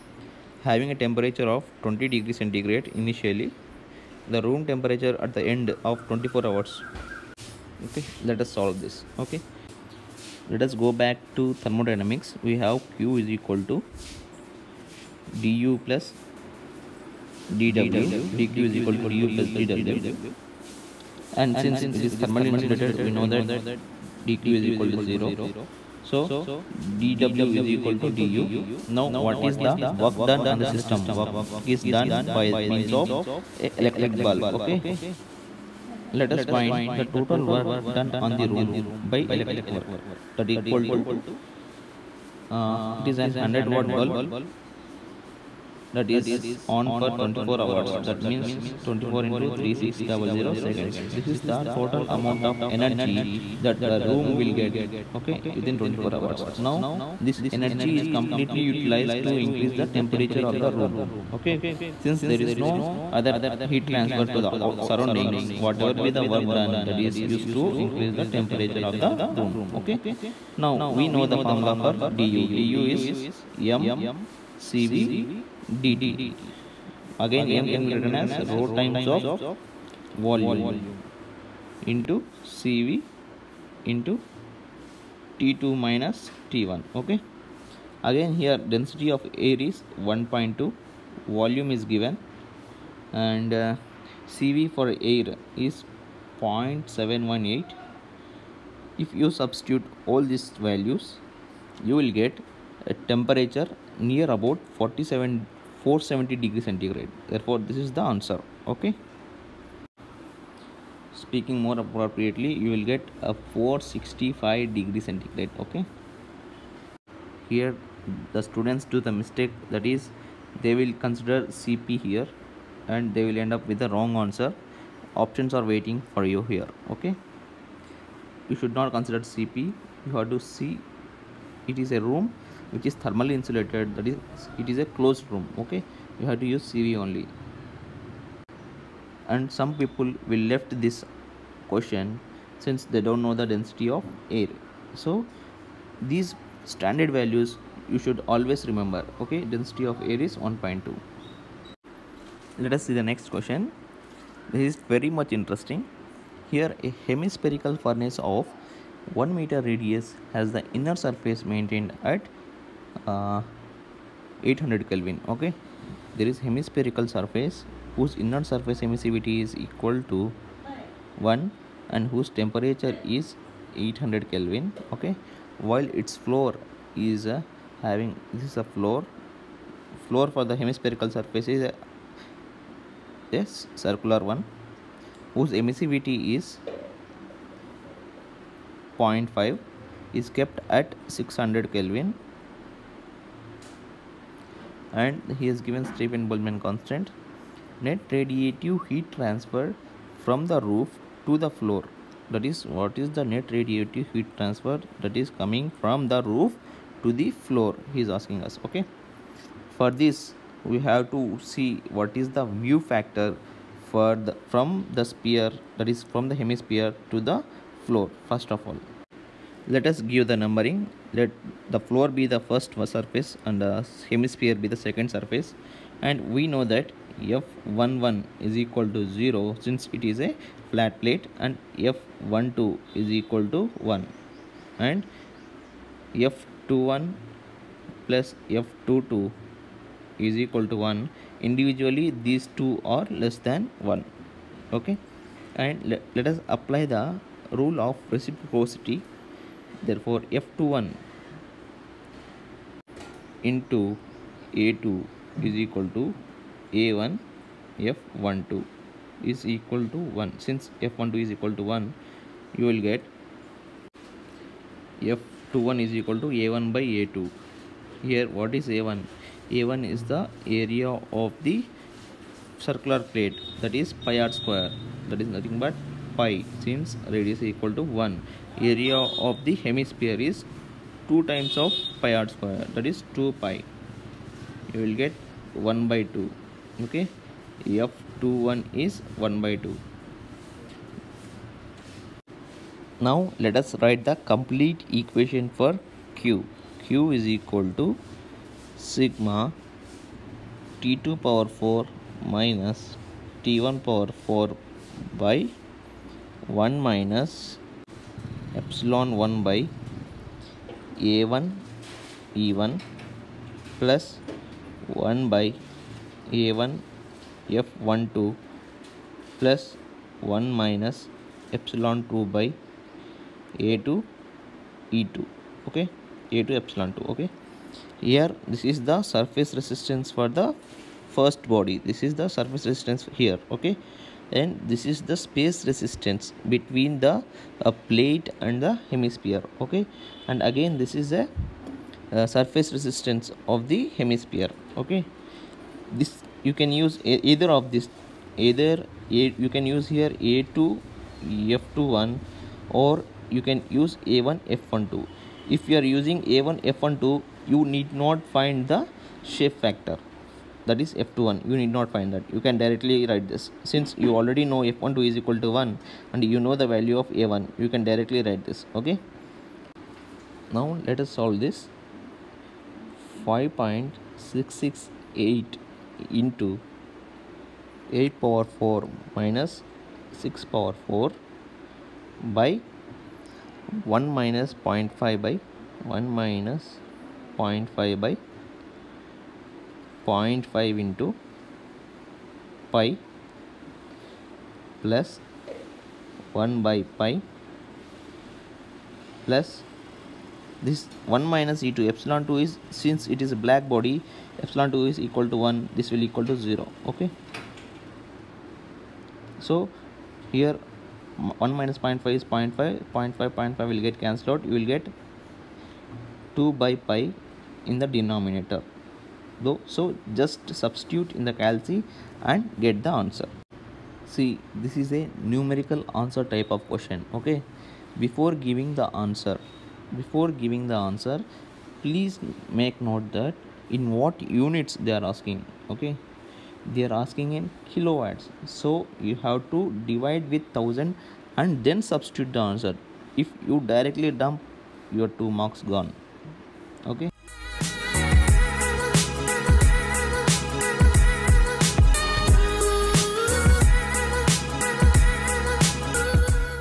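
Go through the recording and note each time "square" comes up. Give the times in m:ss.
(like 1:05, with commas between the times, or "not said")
4:34, 4:42.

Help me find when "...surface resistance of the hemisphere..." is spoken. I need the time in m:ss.
5:42.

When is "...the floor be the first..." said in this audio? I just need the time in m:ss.
3:41.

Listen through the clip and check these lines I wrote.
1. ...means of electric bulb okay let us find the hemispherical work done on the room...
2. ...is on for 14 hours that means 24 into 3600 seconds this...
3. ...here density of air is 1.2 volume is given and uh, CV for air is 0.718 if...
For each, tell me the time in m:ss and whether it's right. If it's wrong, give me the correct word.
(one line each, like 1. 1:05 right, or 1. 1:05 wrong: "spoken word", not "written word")
1. 0:32 wrong: "total", not "hemispherical"
2. 0:46 wrong: "24", not "14"
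3. 1:28 right.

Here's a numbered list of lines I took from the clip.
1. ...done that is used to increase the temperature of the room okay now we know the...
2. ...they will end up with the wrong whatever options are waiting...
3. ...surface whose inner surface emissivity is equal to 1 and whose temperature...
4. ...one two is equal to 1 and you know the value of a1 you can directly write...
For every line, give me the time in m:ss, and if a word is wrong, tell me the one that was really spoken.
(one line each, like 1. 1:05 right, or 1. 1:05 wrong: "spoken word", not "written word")
1. 1:06 right
2. 2:03 wrong: "answer", not "whatever"
3. 2:47 right
4. 6:04 right.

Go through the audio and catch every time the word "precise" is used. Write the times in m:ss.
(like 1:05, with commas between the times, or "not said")
not said.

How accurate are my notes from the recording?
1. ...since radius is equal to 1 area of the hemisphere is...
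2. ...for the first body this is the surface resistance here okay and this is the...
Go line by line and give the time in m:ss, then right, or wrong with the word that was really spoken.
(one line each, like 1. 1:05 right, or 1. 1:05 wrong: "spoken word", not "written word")
1. 4:36 right
2. 5:30 right.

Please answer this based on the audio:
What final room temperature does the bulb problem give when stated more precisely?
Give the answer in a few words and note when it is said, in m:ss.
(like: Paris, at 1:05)
465 degree centigrade, at 1:53.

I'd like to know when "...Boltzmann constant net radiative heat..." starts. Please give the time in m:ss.
3:16.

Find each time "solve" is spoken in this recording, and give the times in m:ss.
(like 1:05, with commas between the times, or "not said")
0:08, 6:11.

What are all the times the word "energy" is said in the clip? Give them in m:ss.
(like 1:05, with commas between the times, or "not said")
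0:52, 0:57.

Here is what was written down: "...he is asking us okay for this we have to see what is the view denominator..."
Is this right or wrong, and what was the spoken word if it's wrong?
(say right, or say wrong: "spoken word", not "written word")
wrong: "factor", not "denominator".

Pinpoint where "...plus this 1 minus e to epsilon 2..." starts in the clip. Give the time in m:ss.
6:39.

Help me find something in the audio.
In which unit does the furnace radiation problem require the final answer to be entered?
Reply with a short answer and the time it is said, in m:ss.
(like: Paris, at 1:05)
kilowatts, at 7:17.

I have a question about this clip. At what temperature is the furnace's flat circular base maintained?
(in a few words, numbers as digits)
600 kelvin.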